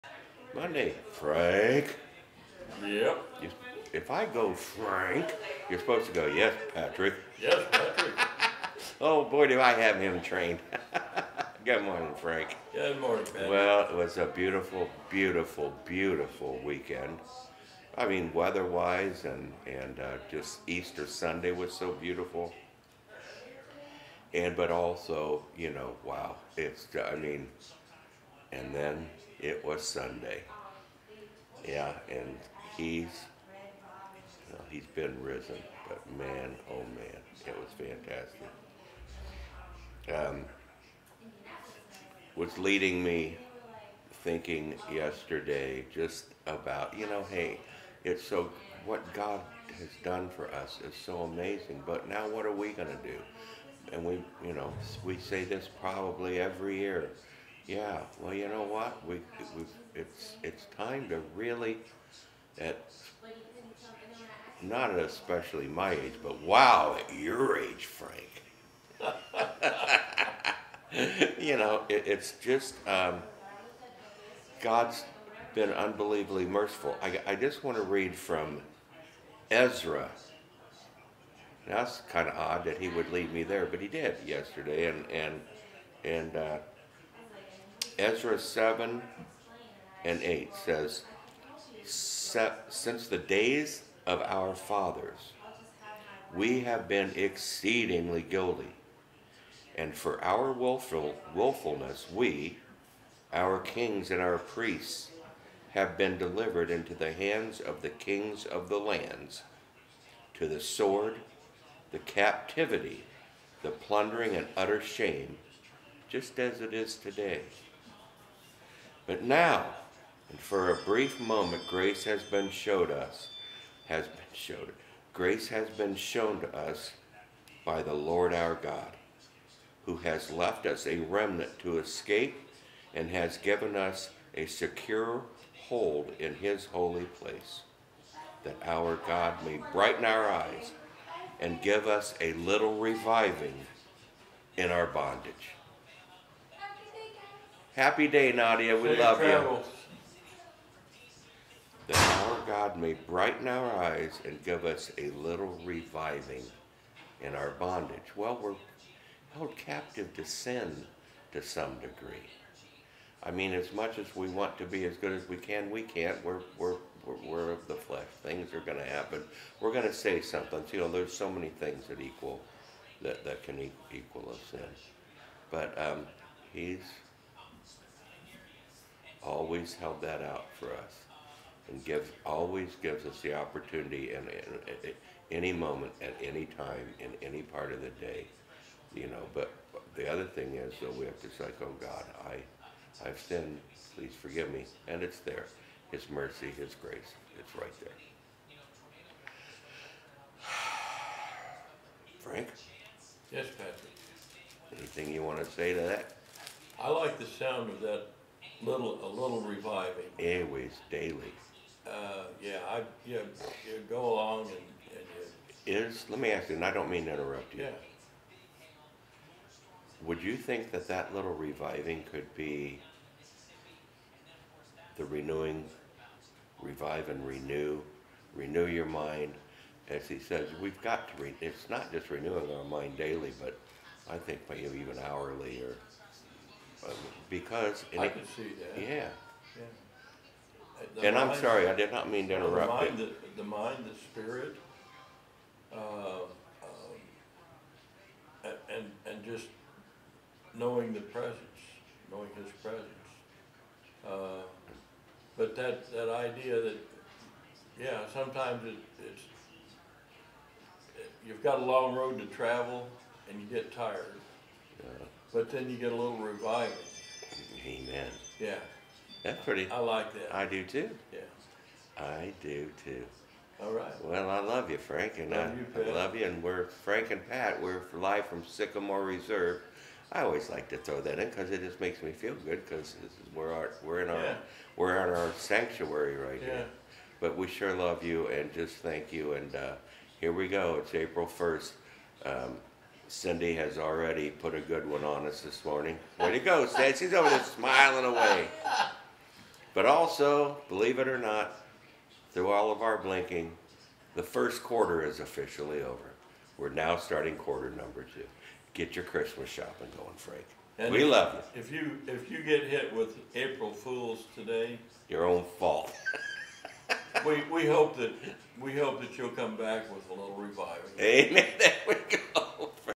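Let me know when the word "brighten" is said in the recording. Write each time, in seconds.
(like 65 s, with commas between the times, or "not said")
139 s, 152 s.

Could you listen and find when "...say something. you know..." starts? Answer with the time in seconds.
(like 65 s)
169 s.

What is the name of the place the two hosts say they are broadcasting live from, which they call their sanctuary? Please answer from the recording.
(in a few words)
Sycamore Reserve.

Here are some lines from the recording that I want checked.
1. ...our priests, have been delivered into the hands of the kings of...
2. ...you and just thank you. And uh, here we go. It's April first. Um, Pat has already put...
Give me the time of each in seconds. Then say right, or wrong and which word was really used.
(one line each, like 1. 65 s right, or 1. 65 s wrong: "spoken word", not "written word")
1. 104 s right
2. 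288 s wrong: "Cindy", not "Pat".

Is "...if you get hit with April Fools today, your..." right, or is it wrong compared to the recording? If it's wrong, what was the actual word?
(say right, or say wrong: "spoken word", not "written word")
right.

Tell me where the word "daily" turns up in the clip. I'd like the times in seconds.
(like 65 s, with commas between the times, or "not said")
210 s, 232 s.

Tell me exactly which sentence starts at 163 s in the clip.
I mean, as much as we want to be as good as we can, we can't.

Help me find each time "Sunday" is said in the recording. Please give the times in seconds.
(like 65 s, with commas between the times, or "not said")
21 s, 29 s.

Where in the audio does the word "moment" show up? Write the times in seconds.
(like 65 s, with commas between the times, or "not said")
121 s, 185 s.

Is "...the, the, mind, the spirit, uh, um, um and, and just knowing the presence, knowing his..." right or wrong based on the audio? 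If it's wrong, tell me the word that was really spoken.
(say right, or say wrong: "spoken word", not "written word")
right.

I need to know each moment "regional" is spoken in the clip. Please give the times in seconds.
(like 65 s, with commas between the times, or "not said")
not said.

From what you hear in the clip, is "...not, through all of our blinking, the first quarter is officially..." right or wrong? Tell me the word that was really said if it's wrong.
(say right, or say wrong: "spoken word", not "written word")
right.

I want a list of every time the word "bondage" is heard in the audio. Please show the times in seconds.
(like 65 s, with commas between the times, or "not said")
144 s, 157 s.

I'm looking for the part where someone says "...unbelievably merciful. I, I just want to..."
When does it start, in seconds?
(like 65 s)
75 s.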